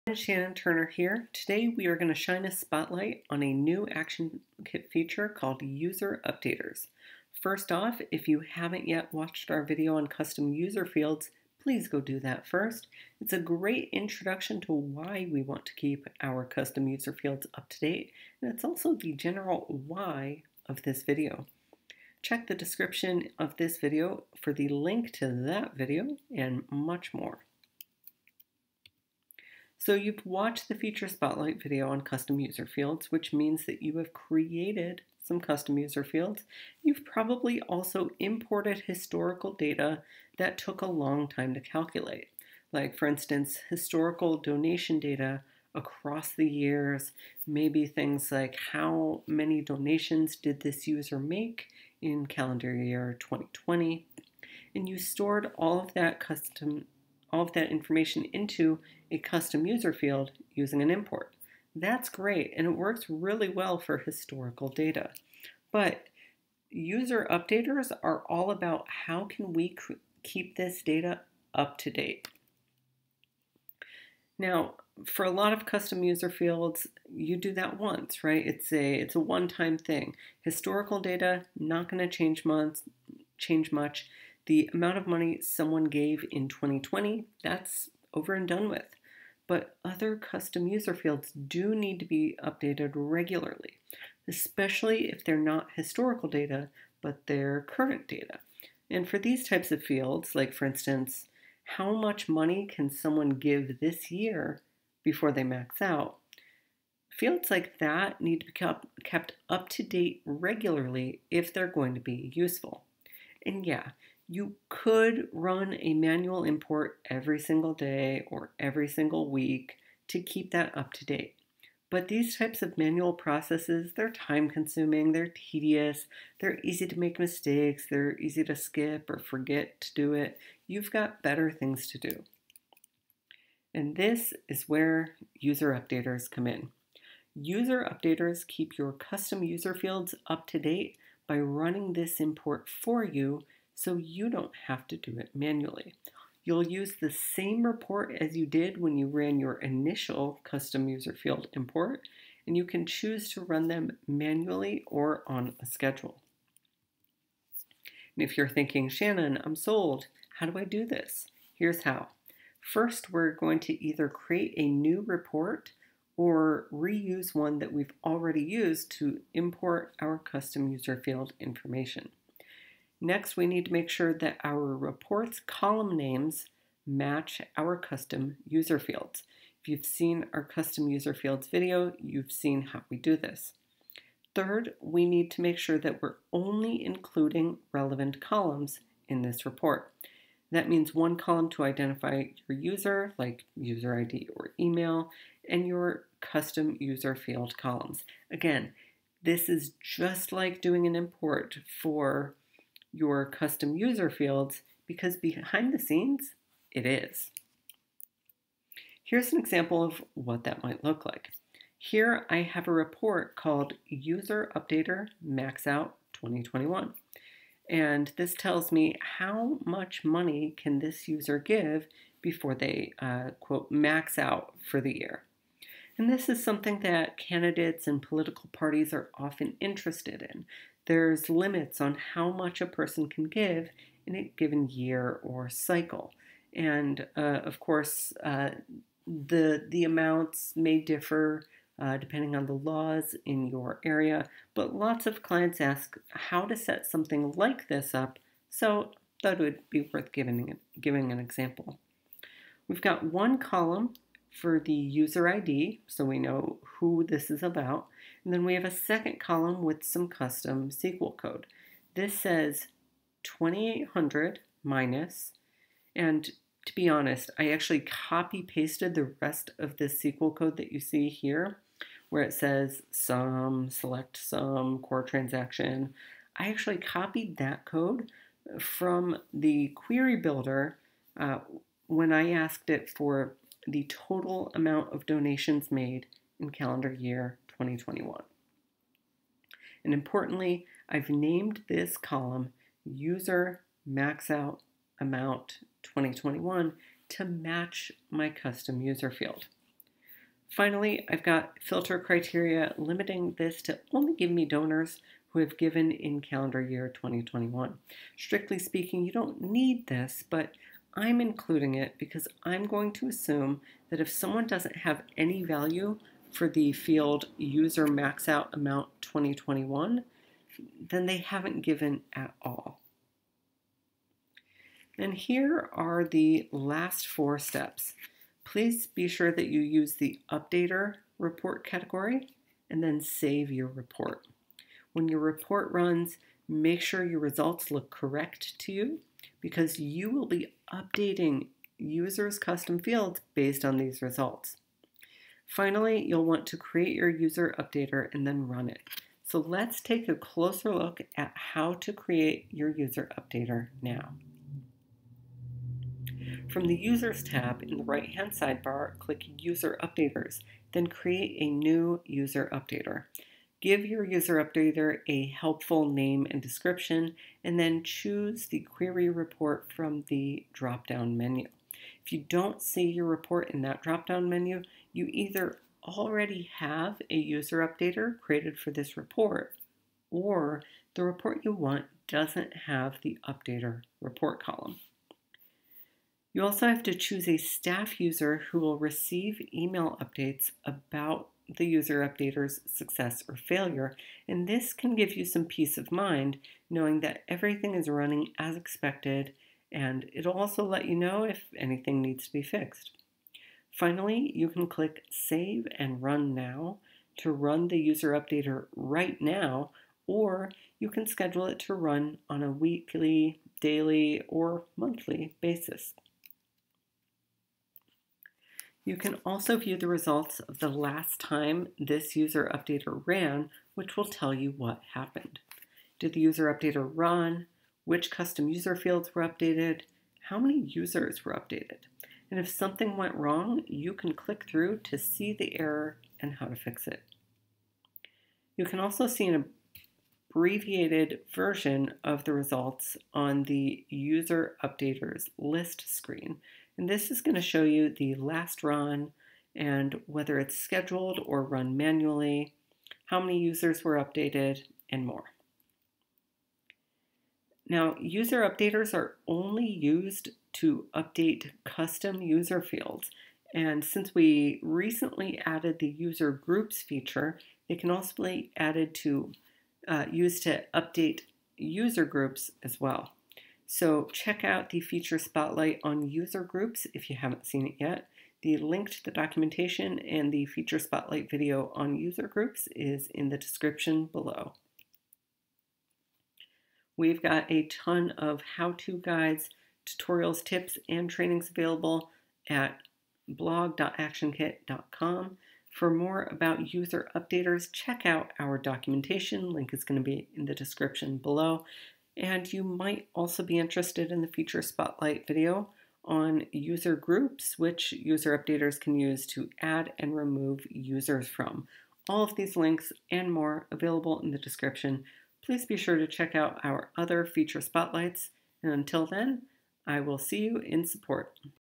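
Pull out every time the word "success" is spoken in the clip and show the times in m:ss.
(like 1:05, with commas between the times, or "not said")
6:32.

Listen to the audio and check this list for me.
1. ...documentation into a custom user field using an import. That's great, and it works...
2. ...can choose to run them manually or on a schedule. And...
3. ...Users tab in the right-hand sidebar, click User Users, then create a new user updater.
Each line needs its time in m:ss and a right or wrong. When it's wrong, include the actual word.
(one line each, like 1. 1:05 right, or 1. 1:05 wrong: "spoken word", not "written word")
1. 0:57 wrong: "information", not "documentation"
2. 2:32 right
3. 5:56 wrong: "Updaters", not "Users".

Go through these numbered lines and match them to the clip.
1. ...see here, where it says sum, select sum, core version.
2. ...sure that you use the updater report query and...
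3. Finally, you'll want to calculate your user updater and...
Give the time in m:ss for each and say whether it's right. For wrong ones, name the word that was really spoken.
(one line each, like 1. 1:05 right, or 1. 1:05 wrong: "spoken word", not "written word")
1. 4:30 wrong: "transaction", not "version"
2. 5:29 wrong: "category", not "query"
3. 5:45 wrong: "create", not "calculate".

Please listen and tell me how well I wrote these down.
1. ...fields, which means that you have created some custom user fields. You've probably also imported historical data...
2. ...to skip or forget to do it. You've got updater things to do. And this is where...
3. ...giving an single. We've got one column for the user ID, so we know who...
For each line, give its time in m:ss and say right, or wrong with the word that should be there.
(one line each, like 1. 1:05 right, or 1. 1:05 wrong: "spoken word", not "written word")
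1. 0:32 right
2. 2:08 wrong: "better", not "updater"
3. 4:10 wrong: "example", not "single".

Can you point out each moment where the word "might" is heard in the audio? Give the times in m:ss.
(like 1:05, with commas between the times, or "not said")
3:30, 8:22.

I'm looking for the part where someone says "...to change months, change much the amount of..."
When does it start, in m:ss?
1:21.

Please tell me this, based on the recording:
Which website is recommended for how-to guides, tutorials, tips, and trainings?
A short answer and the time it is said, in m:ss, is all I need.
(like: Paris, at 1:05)
blog.actionkit.com, at 8:13.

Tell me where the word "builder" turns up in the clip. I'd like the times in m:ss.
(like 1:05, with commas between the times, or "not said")
4:40.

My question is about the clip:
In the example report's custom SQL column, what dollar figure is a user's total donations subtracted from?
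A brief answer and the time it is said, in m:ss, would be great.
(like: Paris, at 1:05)
2800, at 4:23.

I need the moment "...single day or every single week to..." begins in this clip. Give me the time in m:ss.
1:57.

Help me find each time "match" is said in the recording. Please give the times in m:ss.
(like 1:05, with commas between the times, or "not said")
2:56, 4:57.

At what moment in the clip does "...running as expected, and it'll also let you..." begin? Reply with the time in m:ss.
6:37.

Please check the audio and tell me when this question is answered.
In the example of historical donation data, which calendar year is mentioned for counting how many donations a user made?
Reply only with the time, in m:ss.
0:52.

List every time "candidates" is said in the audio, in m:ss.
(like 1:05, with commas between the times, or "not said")
3:47.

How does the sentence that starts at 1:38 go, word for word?
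And for these types of fields, like for instance, how much money can someone give this year before they max out?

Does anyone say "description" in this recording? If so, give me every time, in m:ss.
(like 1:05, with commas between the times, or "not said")
0:22, 6:06, 8:03, 8:20, 8:34.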